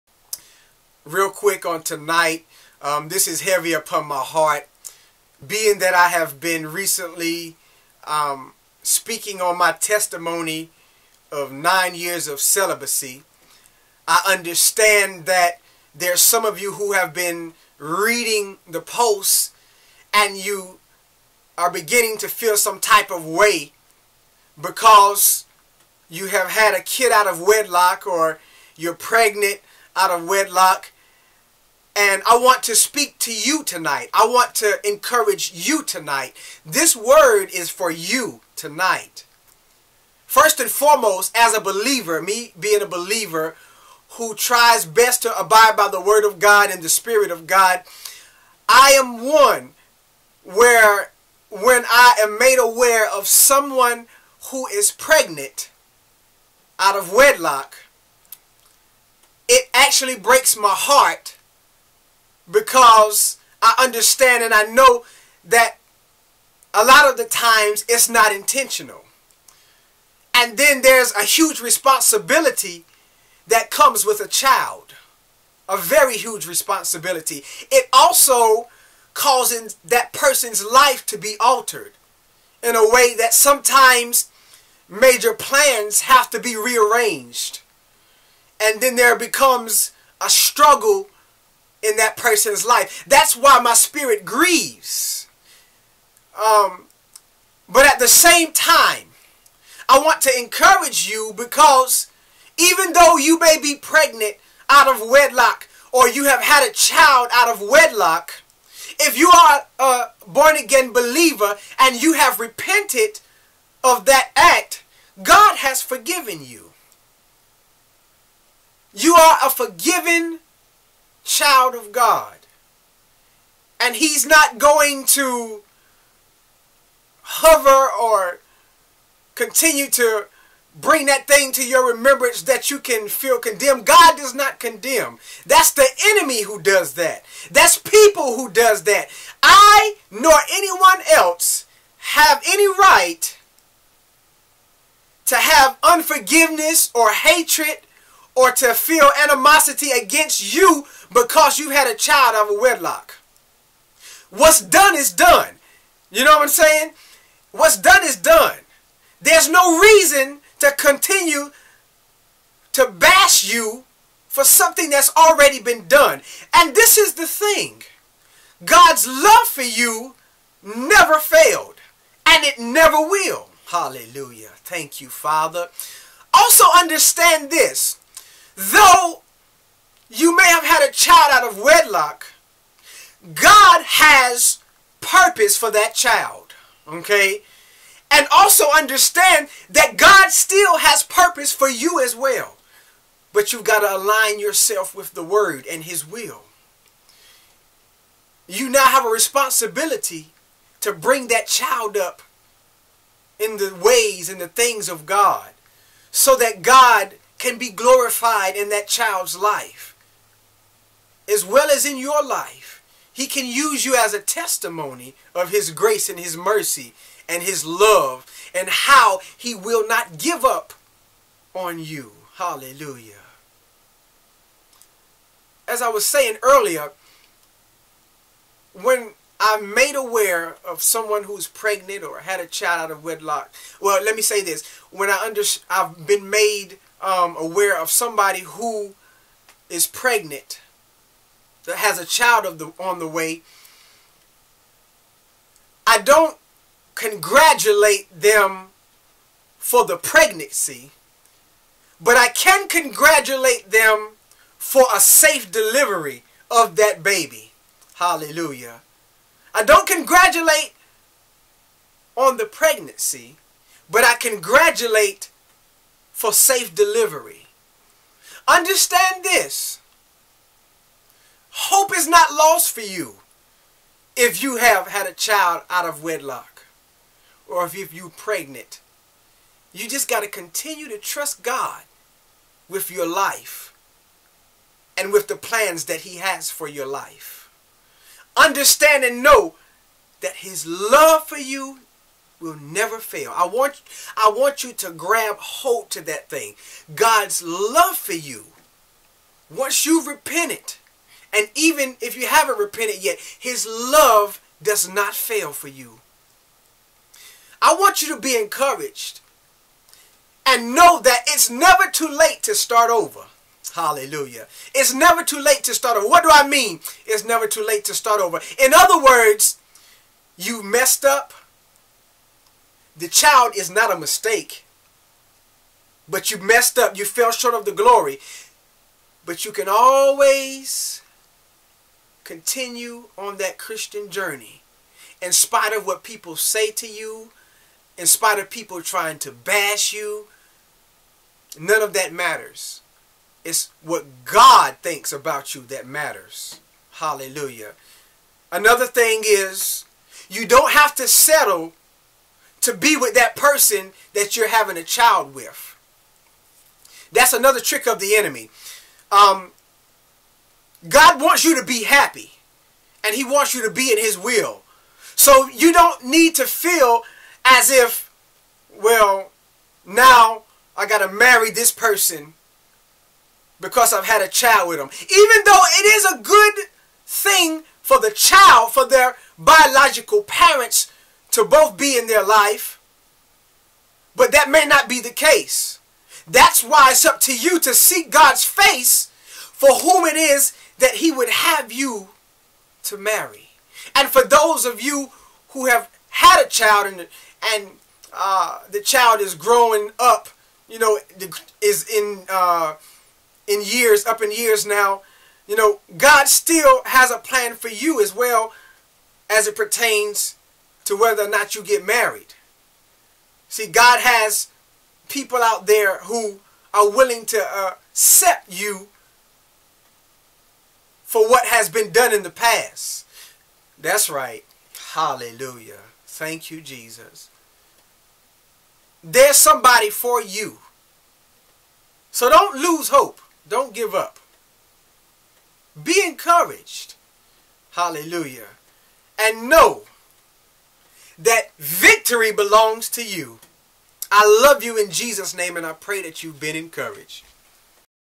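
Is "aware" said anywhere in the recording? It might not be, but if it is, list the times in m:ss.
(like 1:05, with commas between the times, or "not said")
0:52, 3:49, 3:57.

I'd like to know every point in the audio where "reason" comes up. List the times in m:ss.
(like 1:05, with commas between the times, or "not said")
2:39.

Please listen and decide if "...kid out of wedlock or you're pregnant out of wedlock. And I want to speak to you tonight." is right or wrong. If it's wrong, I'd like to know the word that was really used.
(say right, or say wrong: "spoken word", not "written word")
right.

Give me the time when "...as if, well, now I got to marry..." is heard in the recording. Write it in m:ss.
6:07.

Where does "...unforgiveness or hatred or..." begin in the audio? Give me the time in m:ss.
2:25.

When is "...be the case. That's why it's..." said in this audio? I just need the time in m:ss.
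6:24.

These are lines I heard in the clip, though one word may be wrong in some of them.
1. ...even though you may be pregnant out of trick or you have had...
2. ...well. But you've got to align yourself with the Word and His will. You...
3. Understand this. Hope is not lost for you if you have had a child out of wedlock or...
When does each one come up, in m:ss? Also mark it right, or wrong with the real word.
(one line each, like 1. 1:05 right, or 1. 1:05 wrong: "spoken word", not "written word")
1. 1:42 wrong: "wedlock", not "trick"
2. 3:12 right
3. 4:28 right.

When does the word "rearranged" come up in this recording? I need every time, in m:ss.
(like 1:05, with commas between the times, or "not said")
1:26.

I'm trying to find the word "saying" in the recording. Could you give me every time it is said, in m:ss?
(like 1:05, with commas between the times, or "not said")
2:36, 3:46.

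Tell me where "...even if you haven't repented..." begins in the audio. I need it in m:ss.
5:01.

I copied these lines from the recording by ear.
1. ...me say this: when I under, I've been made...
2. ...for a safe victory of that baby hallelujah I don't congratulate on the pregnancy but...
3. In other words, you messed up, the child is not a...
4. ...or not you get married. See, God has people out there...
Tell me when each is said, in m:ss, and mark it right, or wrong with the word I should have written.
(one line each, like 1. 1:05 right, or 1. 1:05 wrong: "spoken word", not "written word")
1. 3:54 right
2. 4:14 wrong: "delivery", not "victory"
3. 5:18 right
4. 6:51 right.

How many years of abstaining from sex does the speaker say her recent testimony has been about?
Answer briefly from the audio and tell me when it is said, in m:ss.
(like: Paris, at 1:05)
9, at 0:11.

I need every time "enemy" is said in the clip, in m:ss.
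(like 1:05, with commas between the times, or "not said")
2:16, 5:58.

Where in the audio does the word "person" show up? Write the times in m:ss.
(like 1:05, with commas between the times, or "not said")
1:20, 1:32, 5:53, 6:11.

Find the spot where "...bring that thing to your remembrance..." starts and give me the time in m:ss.
2:10.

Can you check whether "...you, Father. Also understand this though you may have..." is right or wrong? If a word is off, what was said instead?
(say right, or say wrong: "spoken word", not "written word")
right.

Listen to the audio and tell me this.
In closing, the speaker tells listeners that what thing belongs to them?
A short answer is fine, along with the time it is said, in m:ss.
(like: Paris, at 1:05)
Victory, at 7:21.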